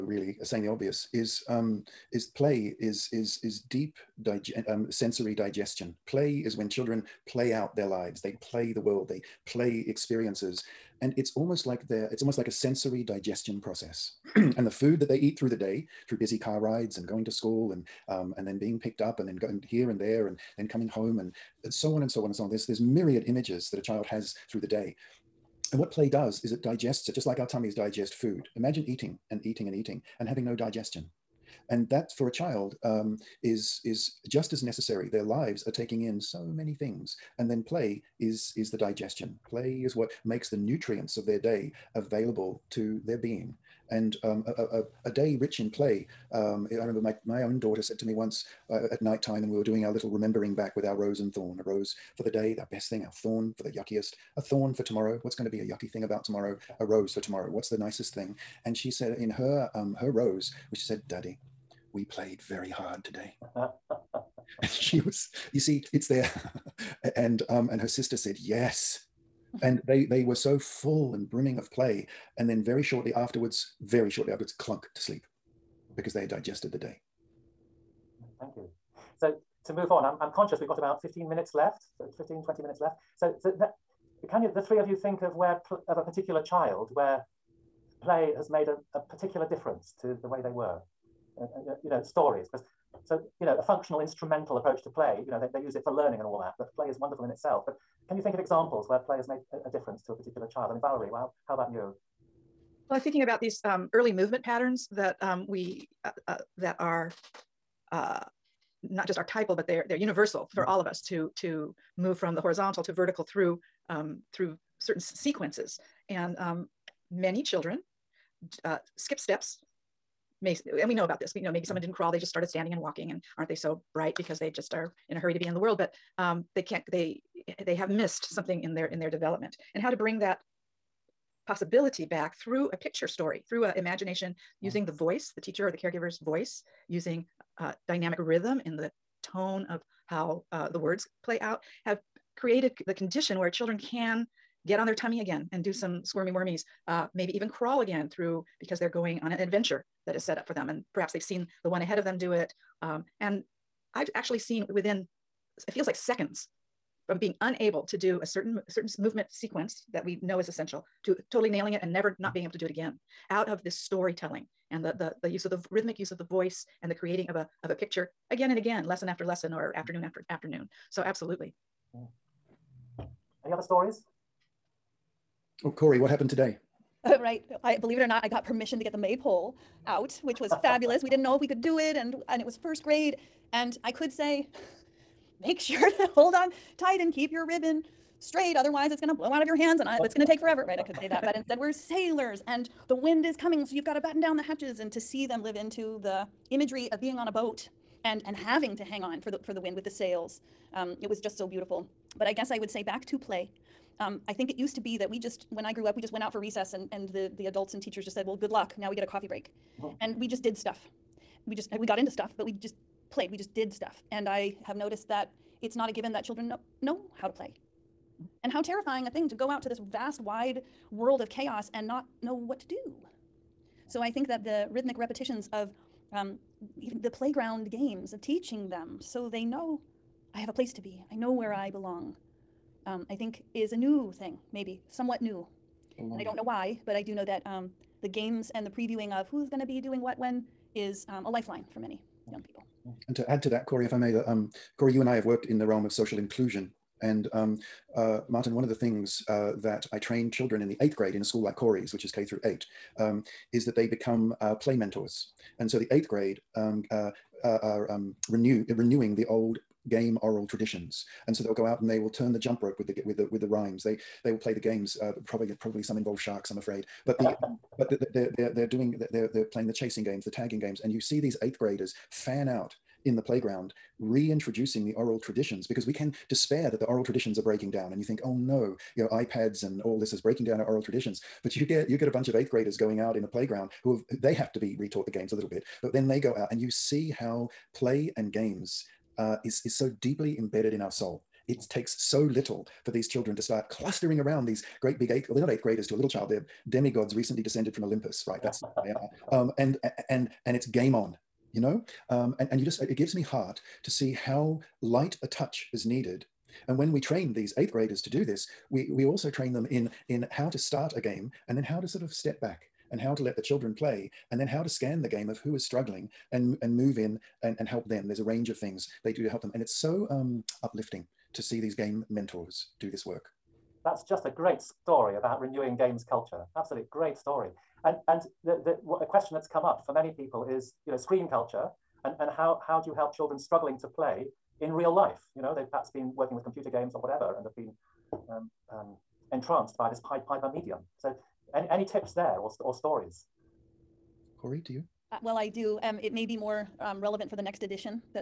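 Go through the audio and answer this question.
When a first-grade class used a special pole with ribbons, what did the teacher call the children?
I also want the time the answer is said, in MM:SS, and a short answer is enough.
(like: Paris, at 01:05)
sailors, at 03:11.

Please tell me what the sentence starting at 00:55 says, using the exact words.
What's going to be a yucky thing about tomorrow?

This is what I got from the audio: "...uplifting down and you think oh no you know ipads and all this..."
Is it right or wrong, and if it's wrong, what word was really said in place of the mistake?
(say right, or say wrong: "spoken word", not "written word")
wrong: "breaking", not "uplifting".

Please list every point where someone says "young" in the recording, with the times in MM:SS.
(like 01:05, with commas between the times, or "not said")
04:02.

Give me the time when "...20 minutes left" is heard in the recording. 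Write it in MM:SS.
01:22.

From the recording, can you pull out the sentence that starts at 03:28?
Now we get a coffee break oh.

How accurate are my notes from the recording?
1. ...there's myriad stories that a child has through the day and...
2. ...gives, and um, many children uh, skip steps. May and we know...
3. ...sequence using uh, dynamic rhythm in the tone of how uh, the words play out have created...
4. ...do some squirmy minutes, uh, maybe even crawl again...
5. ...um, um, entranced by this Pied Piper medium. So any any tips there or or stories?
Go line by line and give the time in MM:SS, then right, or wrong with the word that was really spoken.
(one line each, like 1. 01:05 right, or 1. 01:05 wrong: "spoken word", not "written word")
1. 00:22 wrong: "images", not "stories"
2. 01:55 wrong: "sequences", not "gives"
3. 02:16 wrong: "voice", not "sequence"
4. 02:25 wrong: "wormies", not "minutes"
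5. 05:38 right.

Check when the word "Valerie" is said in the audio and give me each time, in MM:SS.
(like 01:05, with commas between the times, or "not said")
01:40.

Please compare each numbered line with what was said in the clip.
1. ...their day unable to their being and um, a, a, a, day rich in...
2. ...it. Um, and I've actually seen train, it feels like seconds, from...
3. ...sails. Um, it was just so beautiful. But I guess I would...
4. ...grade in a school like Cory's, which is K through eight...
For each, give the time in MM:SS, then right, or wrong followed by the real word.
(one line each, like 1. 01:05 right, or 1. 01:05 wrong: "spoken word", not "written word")
1. 00:41 wrong: "available", not "unable"
2. 02:32 wrong: "within", not "train"
3. 03:19 right
4. 04:10 right.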